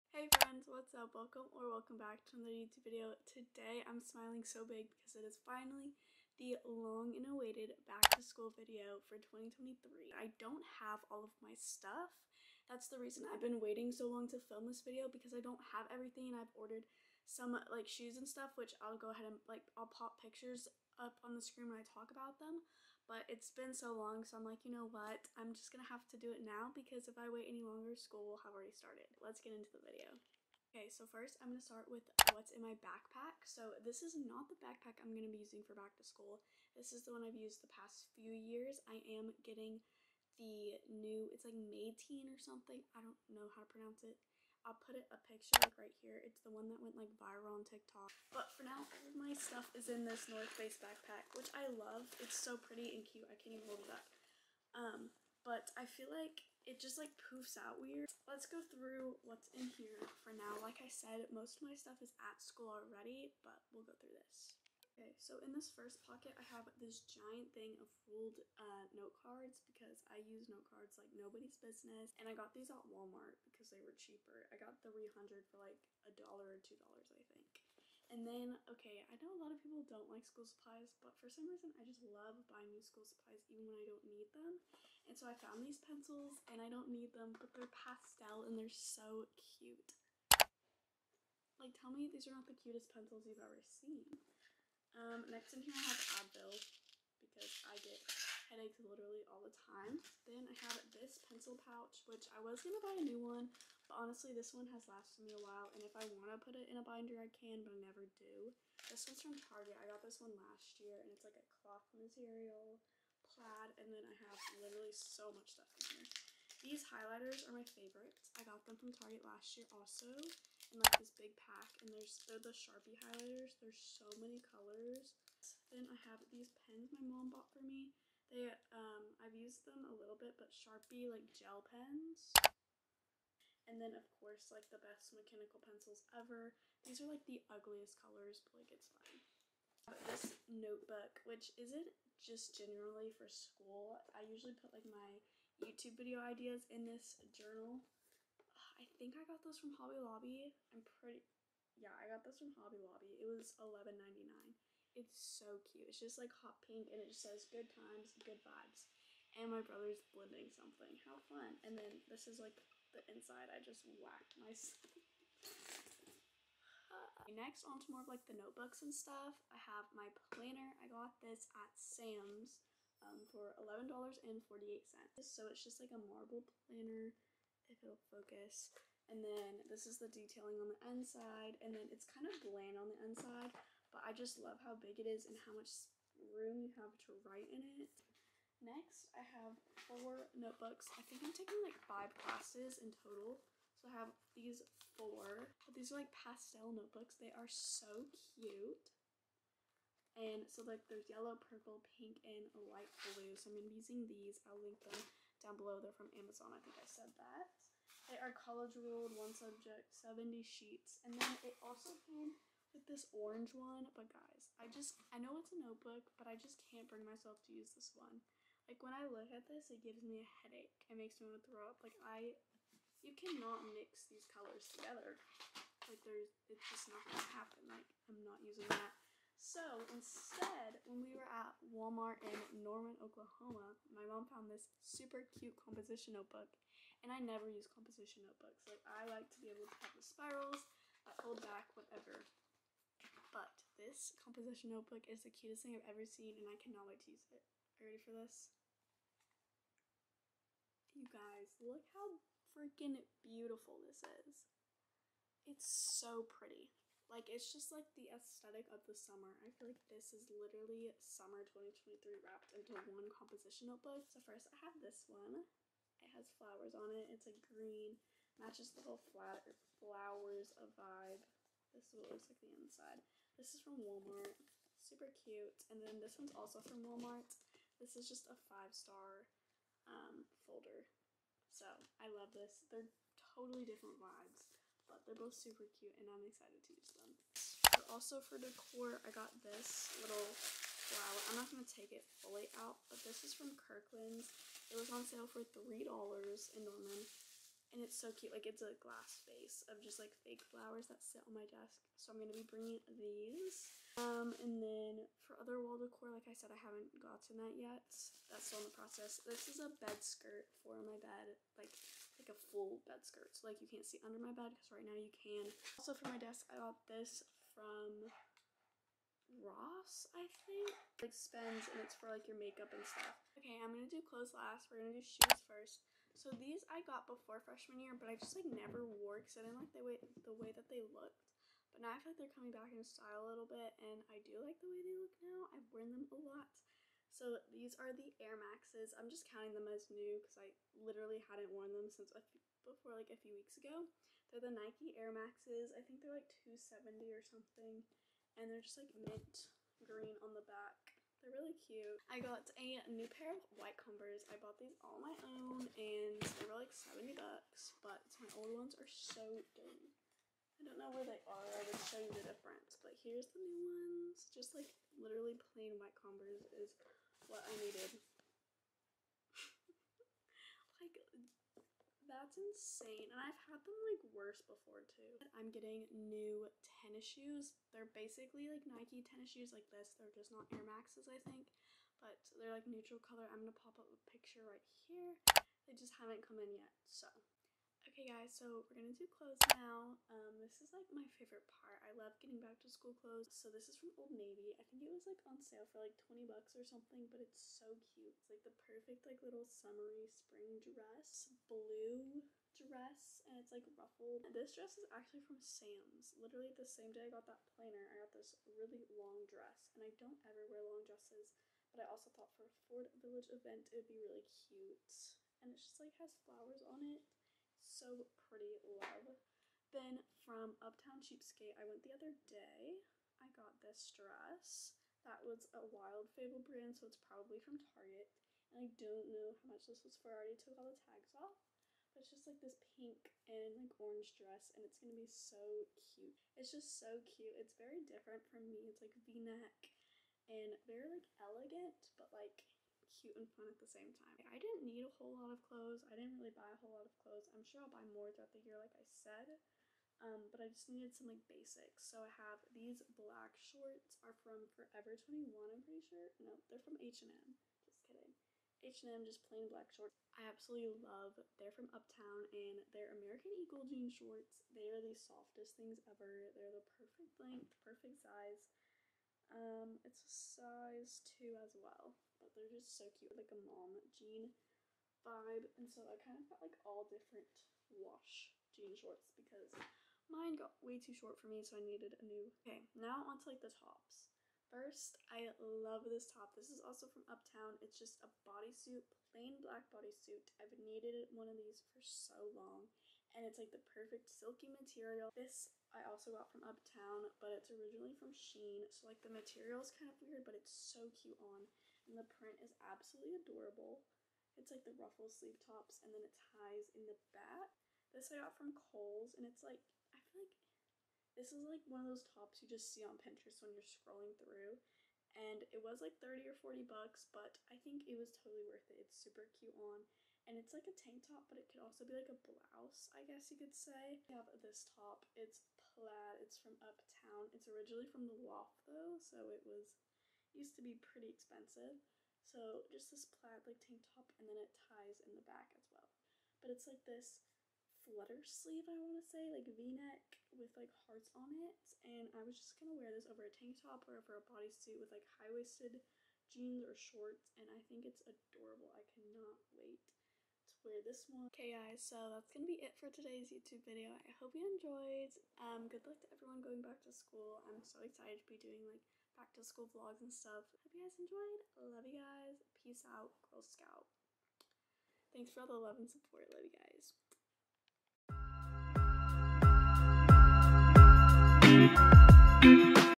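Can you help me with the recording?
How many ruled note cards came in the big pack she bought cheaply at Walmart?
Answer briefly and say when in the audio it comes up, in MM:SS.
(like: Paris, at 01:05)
300, at 01:14.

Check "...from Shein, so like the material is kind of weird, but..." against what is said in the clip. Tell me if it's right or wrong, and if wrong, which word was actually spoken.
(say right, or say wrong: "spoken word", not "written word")
right.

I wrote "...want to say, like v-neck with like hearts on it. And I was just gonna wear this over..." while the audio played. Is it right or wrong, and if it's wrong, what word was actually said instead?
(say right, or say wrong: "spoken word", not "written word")
right.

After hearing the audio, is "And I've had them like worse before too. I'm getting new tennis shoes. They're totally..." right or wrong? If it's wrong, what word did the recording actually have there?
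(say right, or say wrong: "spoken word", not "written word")
wrong: "basically", not "totally".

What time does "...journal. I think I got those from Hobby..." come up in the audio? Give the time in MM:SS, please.
02:27.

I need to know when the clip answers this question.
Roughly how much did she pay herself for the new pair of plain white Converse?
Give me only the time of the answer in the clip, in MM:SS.
05:56.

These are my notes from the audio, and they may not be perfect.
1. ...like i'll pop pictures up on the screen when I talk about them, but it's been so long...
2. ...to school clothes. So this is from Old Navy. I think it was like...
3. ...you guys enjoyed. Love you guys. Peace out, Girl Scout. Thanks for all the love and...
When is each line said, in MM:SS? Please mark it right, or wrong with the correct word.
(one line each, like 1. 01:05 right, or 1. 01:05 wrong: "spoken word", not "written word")
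1. 00:19 right
2. 06:32 right
3. 09:20 right.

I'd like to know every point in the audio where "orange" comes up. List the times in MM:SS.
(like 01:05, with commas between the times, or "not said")
03:33, 07:13.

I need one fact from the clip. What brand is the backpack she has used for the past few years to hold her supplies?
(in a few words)
North Face.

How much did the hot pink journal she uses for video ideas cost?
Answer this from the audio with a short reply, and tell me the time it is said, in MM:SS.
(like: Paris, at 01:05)
$11.99, at 02:33.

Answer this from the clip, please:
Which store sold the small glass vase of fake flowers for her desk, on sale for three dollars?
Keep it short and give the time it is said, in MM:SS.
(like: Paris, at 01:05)
Kirkland's, at 04:53.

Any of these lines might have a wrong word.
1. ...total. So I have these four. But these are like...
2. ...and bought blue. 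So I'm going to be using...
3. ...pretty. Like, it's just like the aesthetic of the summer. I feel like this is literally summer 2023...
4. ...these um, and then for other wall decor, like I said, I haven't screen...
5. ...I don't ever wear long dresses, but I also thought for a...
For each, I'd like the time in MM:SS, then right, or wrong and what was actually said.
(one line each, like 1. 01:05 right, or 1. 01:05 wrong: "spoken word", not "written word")
1. 03:12 right
2. 03:22 wrong: "light", not "bought"
3. 04:16 right
4. 05:02 wrong: "gotten", not "screen"
5. 06:49 right.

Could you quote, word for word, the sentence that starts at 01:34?
Um, next in here I have Advil because I get headaches literally all the time.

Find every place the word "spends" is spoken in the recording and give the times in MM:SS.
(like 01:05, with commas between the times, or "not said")
05:21.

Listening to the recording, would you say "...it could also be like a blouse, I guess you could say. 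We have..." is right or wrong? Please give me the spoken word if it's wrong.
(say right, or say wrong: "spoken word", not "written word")
right.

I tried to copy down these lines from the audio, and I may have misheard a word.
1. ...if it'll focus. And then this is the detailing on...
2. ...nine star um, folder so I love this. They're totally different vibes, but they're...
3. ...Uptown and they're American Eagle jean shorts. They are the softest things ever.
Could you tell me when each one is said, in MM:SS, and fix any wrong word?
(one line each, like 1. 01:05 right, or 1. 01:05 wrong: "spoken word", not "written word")
1. 02:57 right
2. 04:38 wrong: "five", not "nine"
3. 07:41 right.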